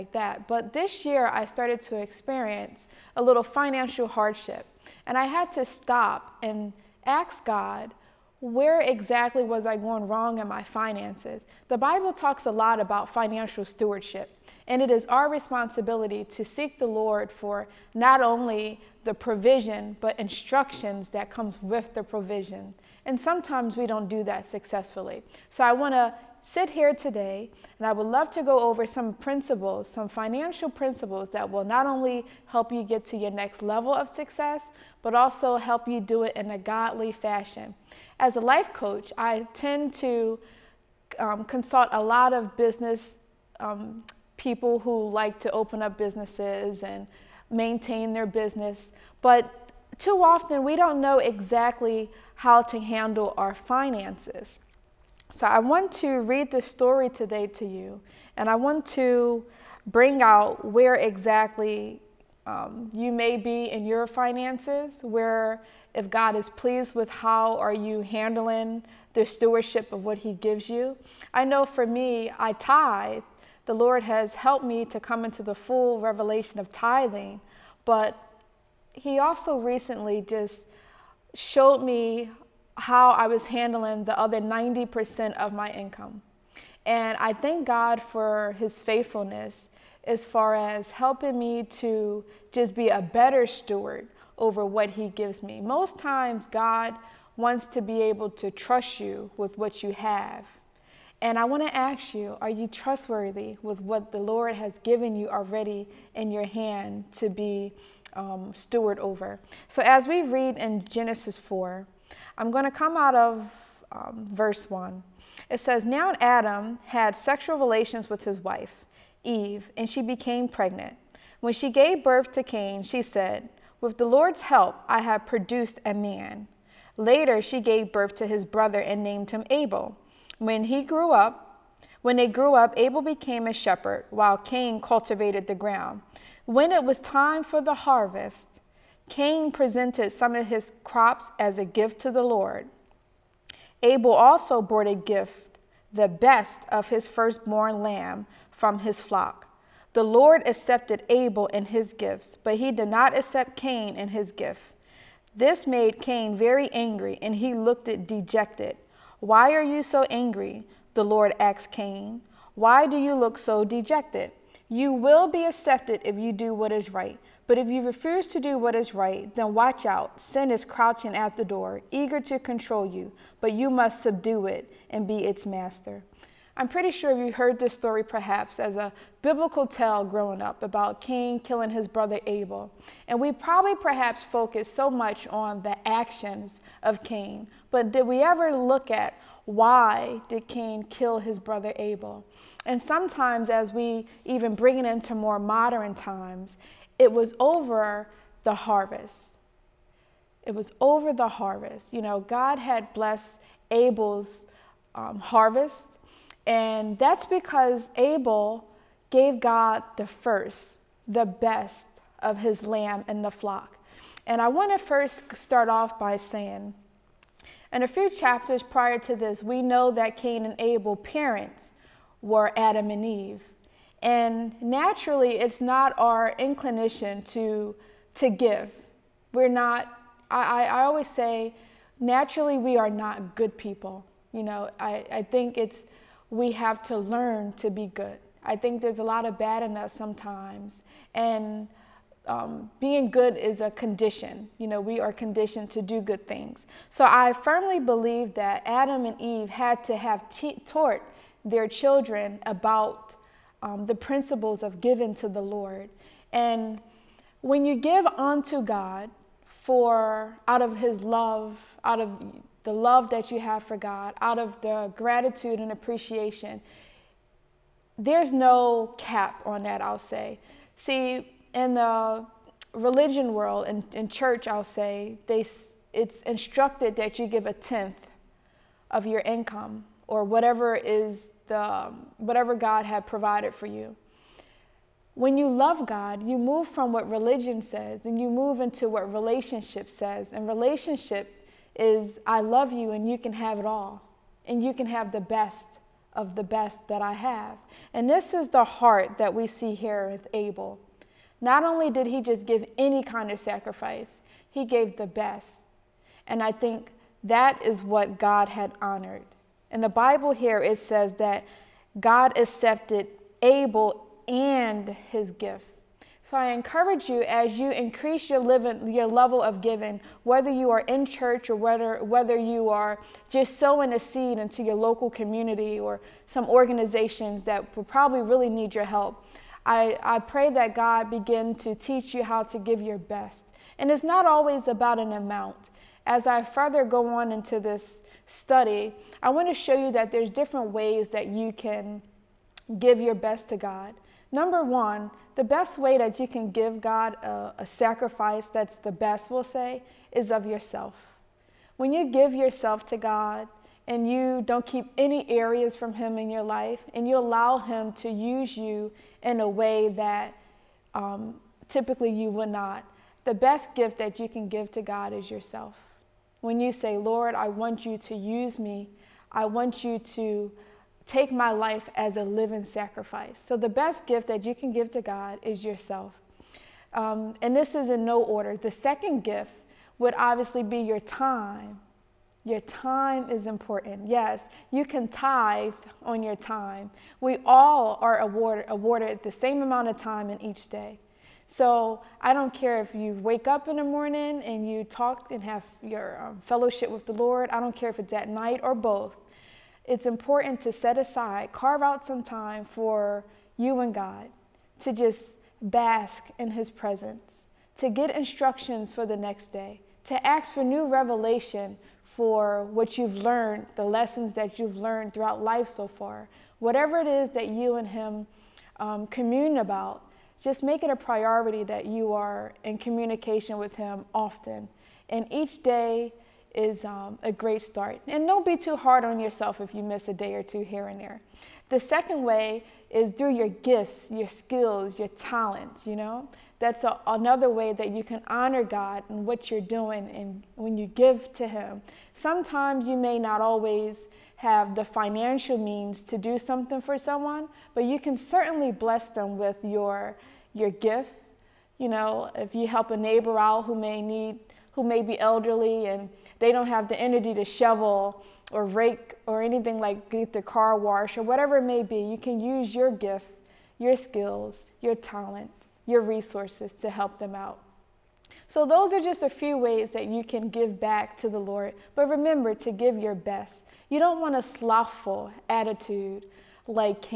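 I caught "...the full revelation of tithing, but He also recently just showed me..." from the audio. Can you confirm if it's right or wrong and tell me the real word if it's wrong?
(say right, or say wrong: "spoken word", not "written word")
right.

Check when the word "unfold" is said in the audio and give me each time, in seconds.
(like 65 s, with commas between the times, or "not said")
not said.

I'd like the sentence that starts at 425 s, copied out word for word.
And each day is um, a great start.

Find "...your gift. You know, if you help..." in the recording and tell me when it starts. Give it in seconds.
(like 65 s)
450 s.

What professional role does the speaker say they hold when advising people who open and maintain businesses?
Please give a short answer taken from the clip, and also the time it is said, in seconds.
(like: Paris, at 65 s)
Life coach, at 38 s.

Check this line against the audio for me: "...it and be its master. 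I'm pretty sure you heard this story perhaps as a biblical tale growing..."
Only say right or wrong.
right.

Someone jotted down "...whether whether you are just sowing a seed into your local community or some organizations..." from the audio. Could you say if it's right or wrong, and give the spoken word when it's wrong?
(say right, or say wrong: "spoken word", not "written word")
right.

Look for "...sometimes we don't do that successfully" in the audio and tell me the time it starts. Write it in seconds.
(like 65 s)
23 s.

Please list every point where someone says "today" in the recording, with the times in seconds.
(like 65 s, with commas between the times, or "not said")
26 s, 57 s.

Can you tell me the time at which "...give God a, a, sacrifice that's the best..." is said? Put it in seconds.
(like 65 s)
346 s.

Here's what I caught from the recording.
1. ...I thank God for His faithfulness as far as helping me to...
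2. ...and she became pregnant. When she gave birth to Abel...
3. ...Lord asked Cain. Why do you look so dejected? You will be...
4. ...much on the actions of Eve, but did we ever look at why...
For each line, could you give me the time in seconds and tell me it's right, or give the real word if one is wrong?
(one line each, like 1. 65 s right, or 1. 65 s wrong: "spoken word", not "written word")
1. 87 s right
2. 119 s wrong: "Cain", not "Abel"
3. 161 s right
4. 184 s wrong: "Cain", not "Eve".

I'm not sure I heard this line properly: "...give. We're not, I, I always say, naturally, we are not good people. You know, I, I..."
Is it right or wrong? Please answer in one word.
right.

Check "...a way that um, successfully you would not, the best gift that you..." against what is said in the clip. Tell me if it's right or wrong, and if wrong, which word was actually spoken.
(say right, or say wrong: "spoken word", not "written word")
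wrong: "typically", not "successfully".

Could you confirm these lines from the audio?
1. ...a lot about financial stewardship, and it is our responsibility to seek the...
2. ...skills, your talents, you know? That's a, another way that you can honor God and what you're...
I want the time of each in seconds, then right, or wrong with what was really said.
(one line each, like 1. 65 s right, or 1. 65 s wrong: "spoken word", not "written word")
1. 12 s right
2. 434 s right.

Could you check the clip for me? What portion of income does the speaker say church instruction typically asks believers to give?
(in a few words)
A tenth.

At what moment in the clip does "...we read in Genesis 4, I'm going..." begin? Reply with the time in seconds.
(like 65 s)
110 s.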